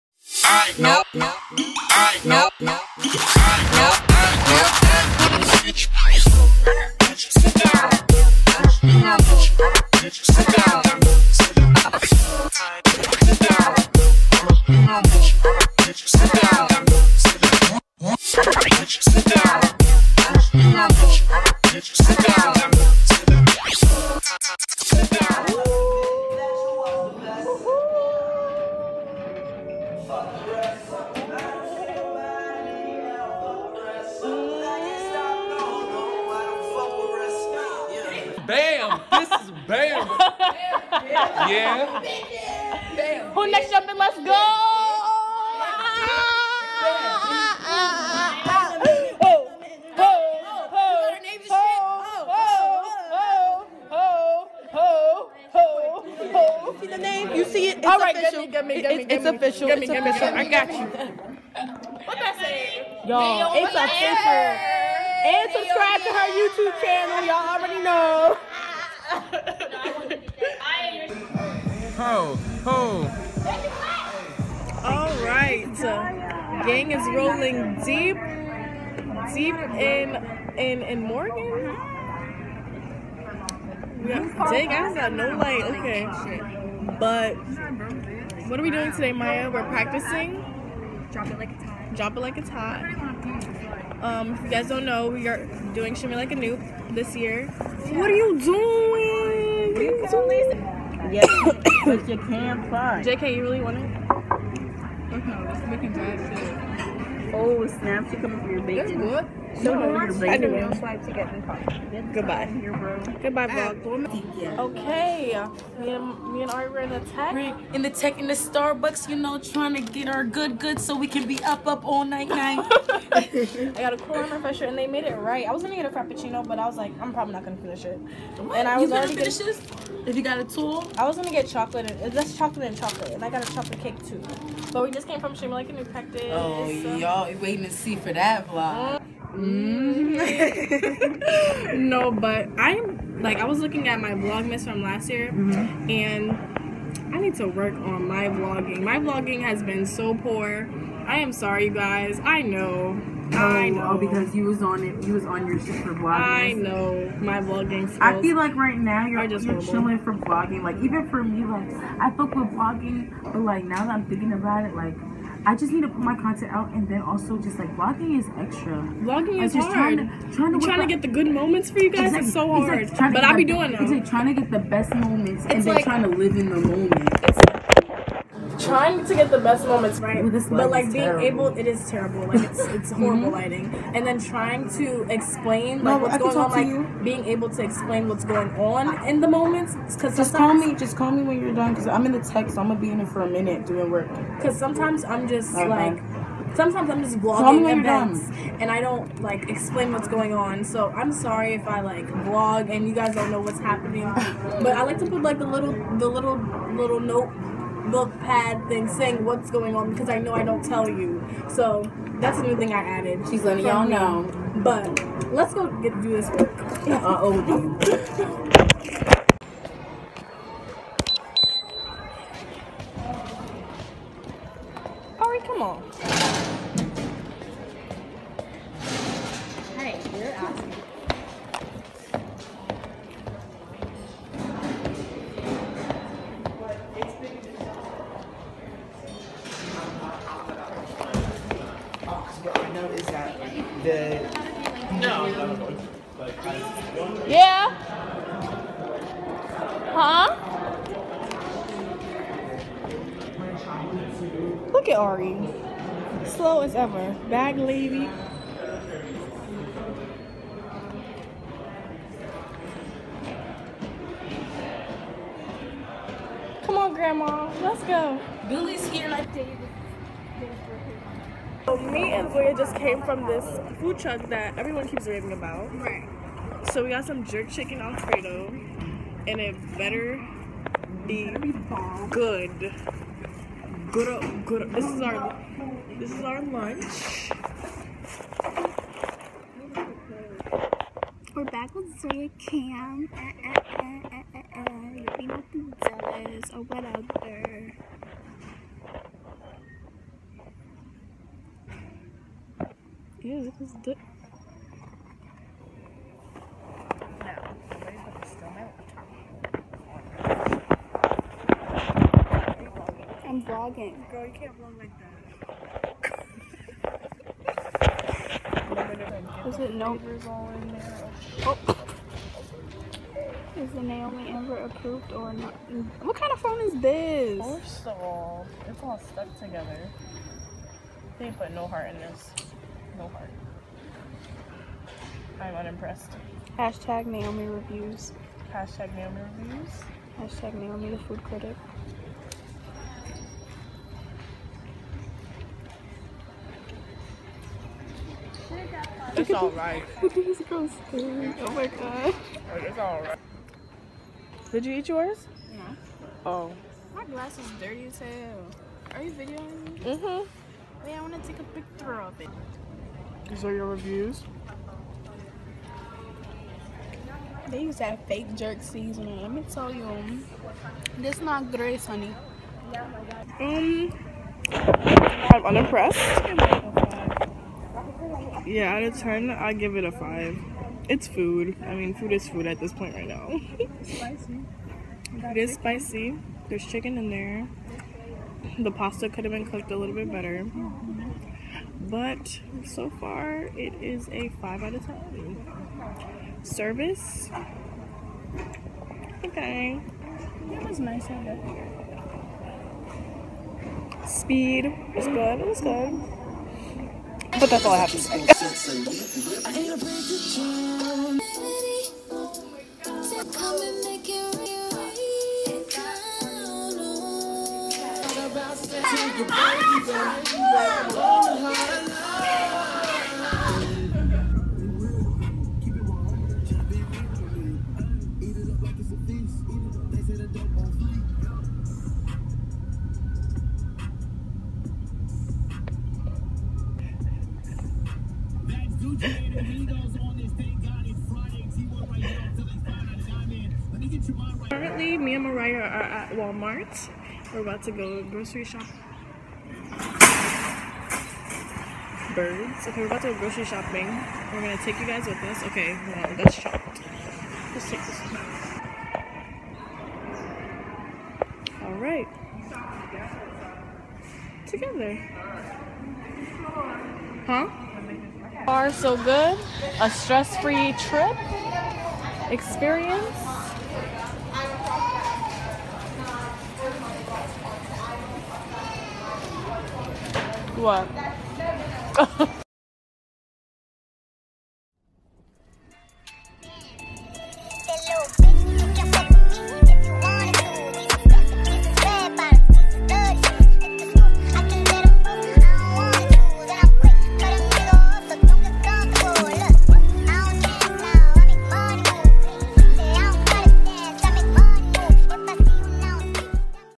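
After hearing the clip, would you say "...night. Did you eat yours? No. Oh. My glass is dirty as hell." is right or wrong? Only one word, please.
wrong.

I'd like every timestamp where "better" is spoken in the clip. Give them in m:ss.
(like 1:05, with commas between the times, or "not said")
4:39, 6:30.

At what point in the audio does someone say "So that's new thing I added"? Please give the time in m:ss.
3:31.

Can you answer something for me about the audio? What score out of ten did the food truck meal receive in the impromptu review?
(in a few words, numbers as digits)
5.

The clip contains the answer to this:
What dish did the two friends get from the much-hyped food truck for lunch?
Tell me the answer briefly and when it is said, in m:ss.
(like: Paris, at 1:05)
jerk chicken alfredo, at 4:37.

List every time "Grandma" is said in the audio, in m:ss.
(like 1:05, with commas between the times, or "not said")
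4:26.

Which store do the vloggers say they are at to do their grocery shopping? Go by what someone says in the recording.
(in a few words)
Walmart.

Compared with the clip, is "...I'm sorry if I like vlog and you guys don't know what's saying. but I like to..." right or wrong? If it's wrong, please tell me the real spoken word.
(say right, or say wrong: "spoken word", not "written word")
wrong: "happening", not "saying".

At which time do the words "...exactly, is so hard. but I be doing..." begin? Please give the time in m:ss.
2:52.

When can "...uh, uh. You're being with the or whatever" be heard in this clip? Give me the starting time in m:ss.
4:54.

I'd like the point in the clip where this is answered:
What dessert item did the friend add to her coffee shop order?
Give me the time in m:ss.
2:13.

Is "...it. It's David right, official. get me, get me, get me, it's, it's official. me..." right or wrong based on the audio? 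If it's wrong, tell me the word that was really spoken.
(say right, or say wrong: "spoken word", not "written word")
wrong: "All", not "David".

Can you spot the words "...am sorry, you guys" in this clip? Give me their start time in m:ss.
2:31.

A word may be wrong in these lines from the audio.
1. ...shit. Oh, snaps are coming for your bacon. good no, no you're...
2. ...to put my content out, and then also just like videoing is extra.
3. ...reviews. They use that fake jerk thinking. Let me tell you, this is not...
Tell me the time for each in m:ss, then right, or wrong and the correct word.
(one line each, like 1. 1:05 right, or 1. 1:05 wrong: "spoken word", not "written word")
1. 1:46 right
2. 2:45 wrong: "vlogging", not "videoing"
3. 6:03 wrong: "seasoning", not "thinking".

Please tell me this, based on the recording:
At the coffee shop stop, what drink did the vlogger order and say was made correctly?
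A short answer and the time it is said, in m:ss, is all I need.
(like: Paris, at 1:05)
Corona refresher, at 2:03.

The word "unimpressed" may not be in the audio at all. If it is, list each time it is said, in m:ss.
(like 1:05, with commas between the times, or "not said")
5:35, 6:15.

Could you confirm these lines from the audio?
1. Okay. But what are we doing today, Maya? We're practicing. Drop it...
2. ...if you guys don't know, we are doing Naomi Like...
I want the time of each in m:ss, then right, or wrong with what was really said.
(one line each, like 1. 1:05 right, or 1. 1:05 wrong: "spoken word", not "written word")
1. 1:25 right
2. 1:34 wrong: "Shimmy", not "Naomi".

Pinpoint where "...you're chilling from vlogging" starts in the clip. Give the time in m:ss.
2:39.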